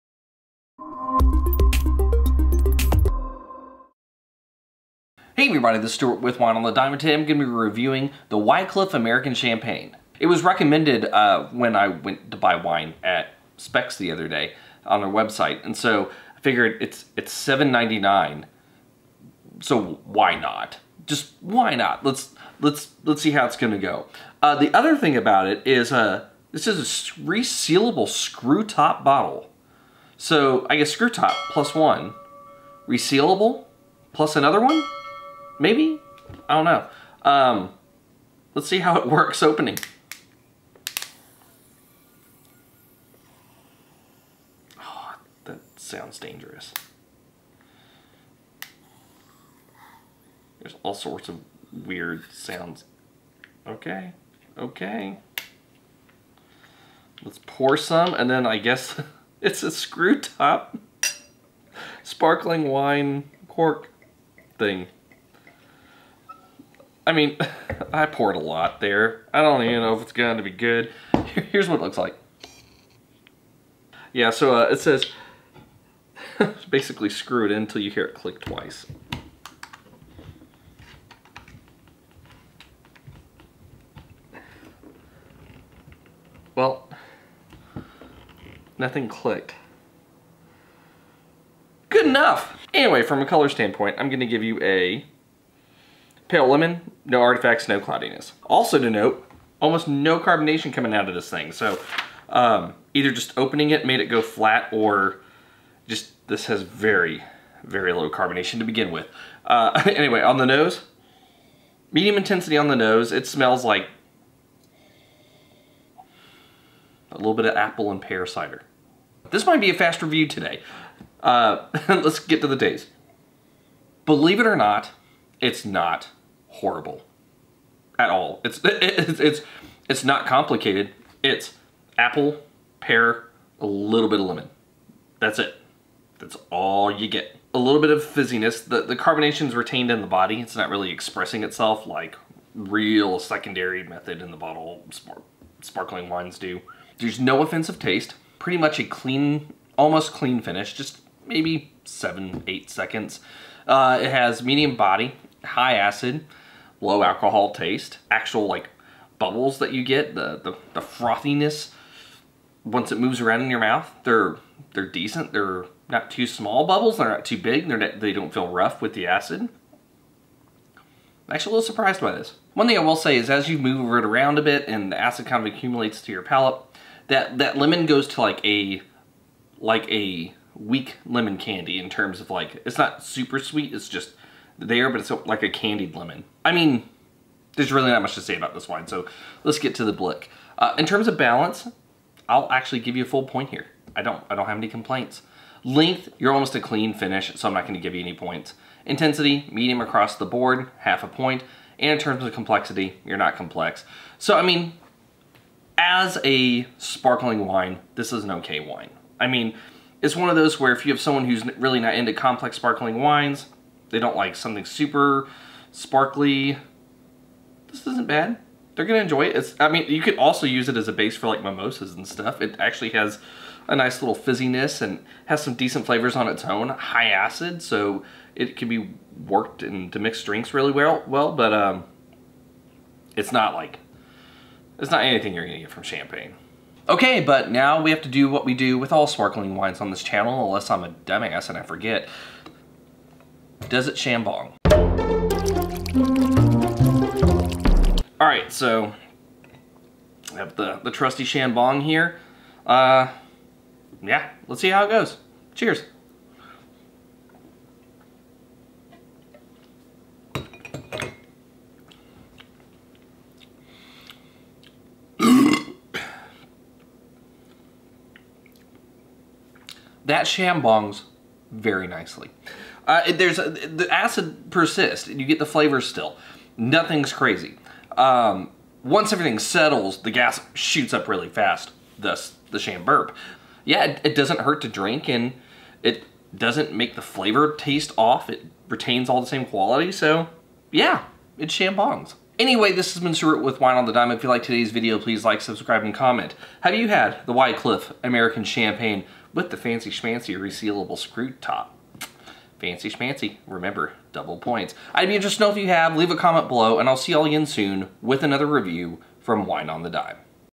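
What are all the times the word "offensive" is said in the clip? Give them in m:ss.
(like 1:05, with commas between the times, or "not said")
2:27.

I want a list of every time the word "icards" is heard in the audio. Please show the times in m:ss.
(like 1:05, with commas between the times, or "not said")
not said.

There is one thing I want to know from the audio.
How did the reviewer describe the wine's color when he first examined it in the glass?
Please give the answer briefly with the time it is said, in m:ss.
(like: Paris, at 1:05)
Pale lemon, at 1:36.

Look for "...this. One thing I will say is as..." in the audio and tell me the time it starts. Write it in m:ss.
2:52.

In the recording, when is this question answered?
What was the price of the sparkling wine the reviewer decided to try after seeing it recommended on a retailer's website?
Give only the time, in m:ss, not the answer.
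0:17.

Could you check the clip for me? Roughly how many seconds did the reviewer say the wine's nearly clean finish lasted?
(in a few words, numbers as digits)
7 to 8 seconds.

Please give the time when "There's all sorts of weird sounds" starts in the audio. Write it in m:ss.
0:50.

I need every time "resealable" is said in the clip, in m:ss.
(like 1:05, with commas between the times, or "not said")
0:27, 0:32, 5:00.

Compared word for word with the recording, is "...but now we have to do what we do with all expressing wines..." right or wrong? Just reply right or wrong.
wrong.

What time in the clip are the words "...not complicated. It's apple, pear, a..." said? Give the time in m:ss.
2:10.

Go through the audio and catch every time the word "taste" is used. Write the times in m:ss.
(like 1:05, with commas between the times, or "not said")
2:02, 2:27, 2:37, 4:47.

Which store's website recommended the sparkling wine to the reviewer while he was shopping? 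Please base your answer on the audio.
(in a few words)
Spec's.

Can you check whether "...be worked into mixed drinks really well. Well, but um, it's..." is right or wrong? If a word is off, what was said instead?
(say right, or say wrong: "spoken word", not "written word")
right.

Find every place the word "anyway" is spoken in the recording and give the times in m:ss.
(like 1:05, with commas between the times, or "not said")
1:32, 1:49, 4:52.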